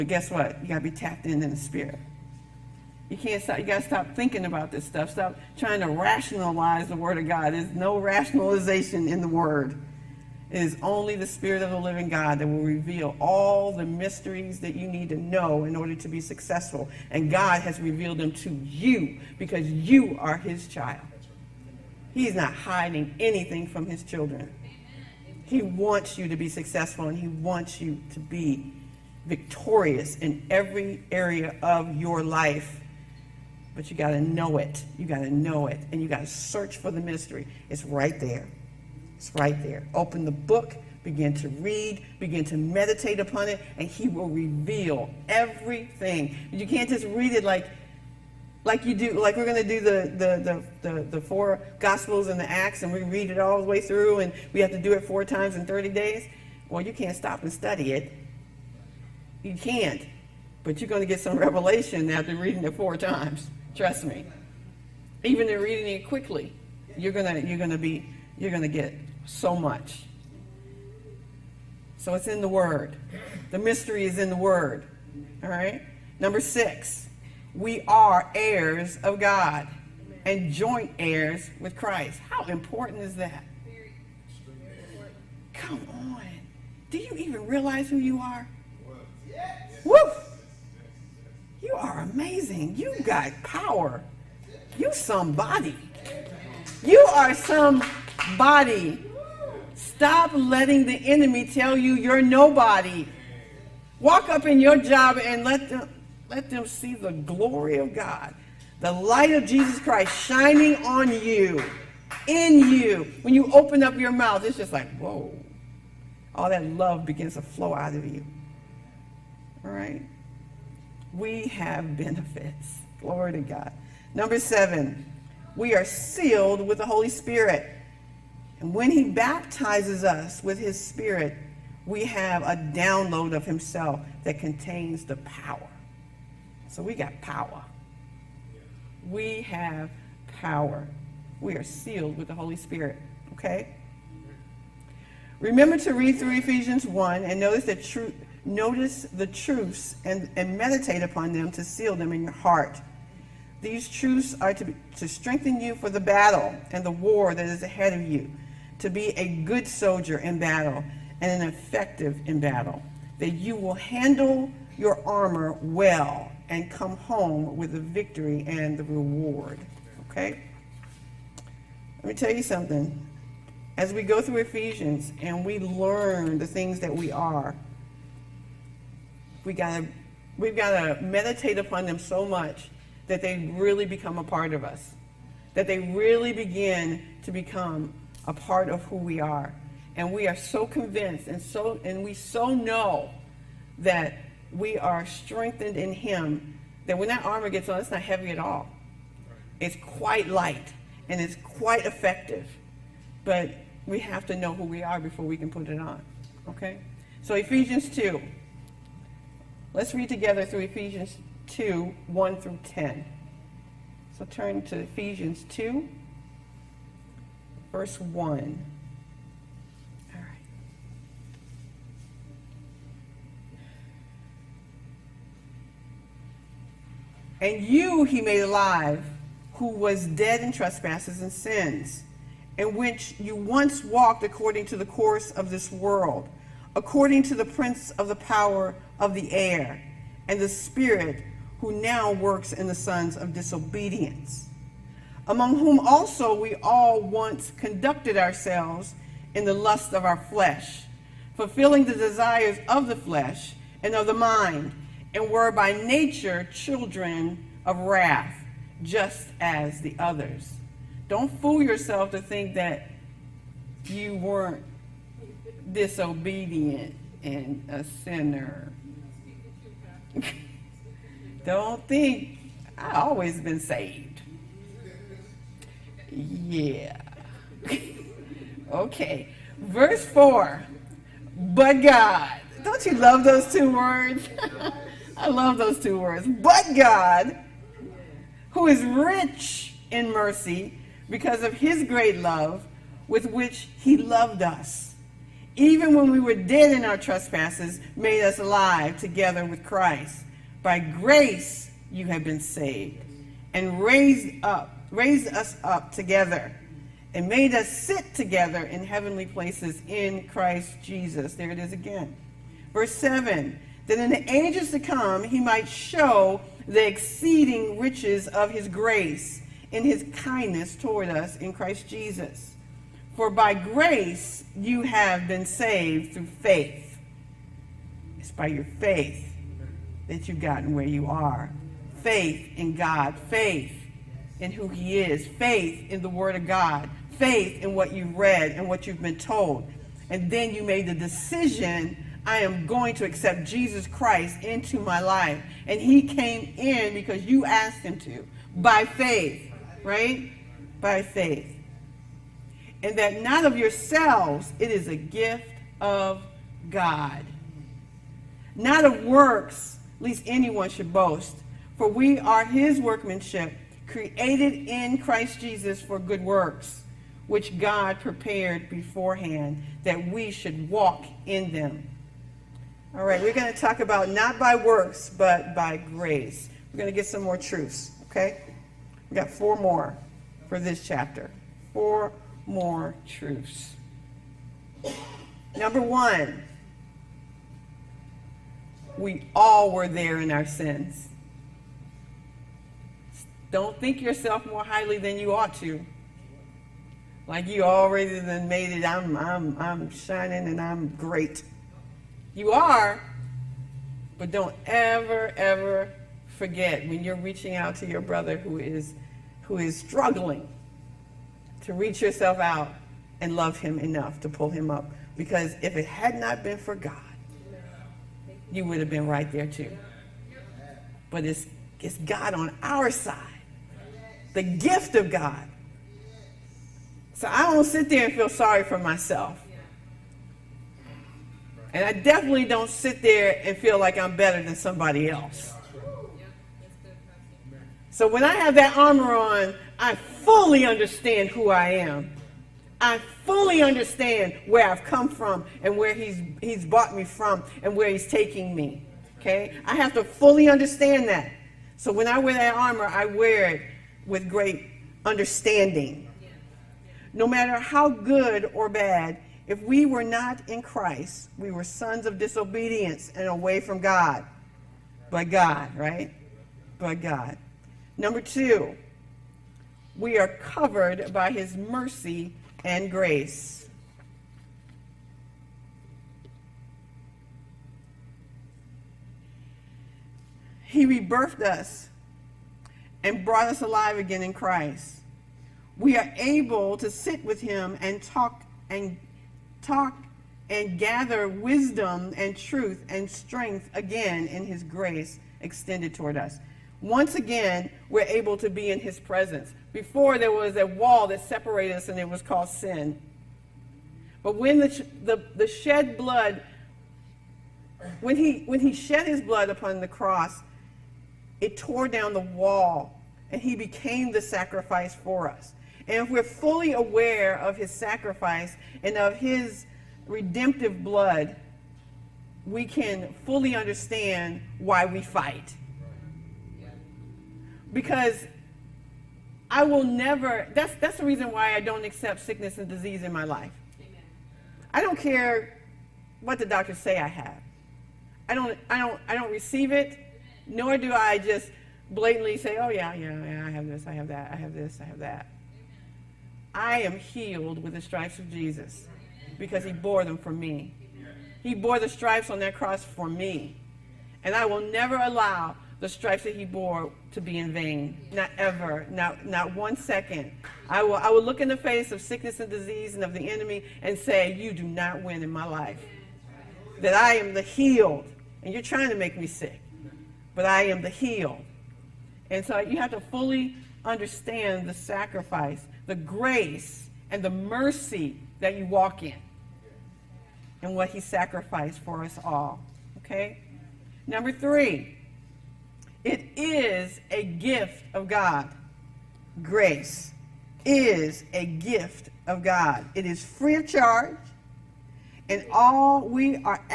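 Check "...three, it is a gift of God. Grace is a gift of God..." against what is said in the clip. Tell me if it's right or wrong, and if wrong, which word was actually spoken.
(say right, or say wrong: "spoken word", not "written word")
right.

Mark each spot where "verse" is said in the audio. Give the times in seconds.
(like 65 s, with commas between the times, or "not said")
217 s, 279 s, 312 s.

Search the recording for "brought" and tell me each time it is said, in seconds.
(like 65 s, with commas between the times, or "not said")
446 s, 483 s.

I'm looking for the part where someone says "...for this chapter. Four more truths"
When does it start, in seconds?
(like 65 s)
380 s.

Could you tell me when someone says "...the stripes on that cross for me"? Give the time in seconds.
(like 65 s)
551 s.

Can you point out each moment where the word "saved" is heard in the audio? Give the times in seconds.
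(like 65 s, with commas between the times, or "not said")
273 s, 302 s, 325 s.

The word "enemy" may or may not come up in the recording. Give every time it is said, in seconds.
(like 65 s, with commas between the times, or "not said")
101 s, 563 s.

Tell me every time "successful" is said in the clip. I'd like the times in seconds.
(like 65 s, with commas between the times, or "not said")
16 s, 26 s.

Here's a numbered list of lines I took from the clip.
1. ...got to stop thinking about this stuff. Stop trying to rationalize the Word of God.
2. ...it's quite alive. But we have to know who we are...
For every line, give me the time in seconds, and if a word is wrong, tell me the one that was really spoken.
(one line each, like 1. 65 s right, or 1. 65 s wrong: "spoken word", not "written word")
1. 3 s right
2. 201 s wrong: "effective", not "alive".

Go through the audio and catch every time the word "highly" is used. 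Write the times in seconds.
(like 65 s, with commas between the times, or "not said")
394 s.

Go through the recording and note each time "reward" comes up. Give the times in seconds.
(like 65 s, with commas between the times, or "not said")
168 s.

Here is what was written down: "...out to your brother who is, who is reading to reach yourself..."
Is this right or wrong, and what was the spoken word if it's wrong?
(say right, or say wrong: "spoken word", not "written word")
wrong: "struggling", not "reading".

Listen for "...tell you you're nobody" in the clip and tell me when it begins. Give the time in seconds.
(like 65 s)
101 s.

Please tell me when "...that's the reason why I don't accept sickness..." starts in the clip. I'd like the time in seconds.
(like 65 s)
530 s.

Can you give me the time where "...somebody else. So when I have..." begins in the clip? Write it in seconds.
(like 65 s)
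434 s.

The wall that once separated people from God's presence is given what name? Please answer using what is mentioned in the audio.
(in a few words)
sin.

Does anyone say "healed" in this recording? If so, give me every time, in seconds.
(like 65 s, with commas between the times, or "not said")
546 s, 567 s.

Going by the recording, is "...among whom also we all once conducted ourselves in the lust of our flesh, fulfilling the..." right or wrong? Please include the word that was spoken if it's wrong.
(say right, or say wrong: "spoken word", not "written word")
right.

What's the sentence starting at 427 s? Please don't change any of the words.
So I don't sit there and feel sorry for myself.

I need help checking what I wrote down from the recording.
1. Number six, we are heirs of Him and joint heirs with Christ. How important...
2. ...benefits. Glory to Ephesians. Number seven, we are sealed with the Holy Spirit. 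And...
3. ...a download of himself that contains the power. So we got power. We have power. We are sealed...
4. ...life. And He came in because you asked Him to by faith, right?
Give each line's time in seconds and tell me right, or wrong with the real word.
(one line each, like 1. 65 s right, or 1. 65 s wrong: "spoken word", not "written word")
1. 76 s wrong: "God", not "Him"
2. 121 s wrong: "God", not "Ephesians"
3. 132 s right
4. 344 s right.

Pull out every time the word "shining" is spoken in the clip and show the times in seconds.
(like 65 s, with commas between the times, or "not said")
110 s, 399 s.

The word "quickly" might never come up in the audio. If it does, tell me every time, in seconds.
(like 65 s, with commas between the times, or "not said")
66 s.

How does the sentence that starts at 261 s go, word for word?
Don't fool yourself to think that you weren't disobedient and a sinner.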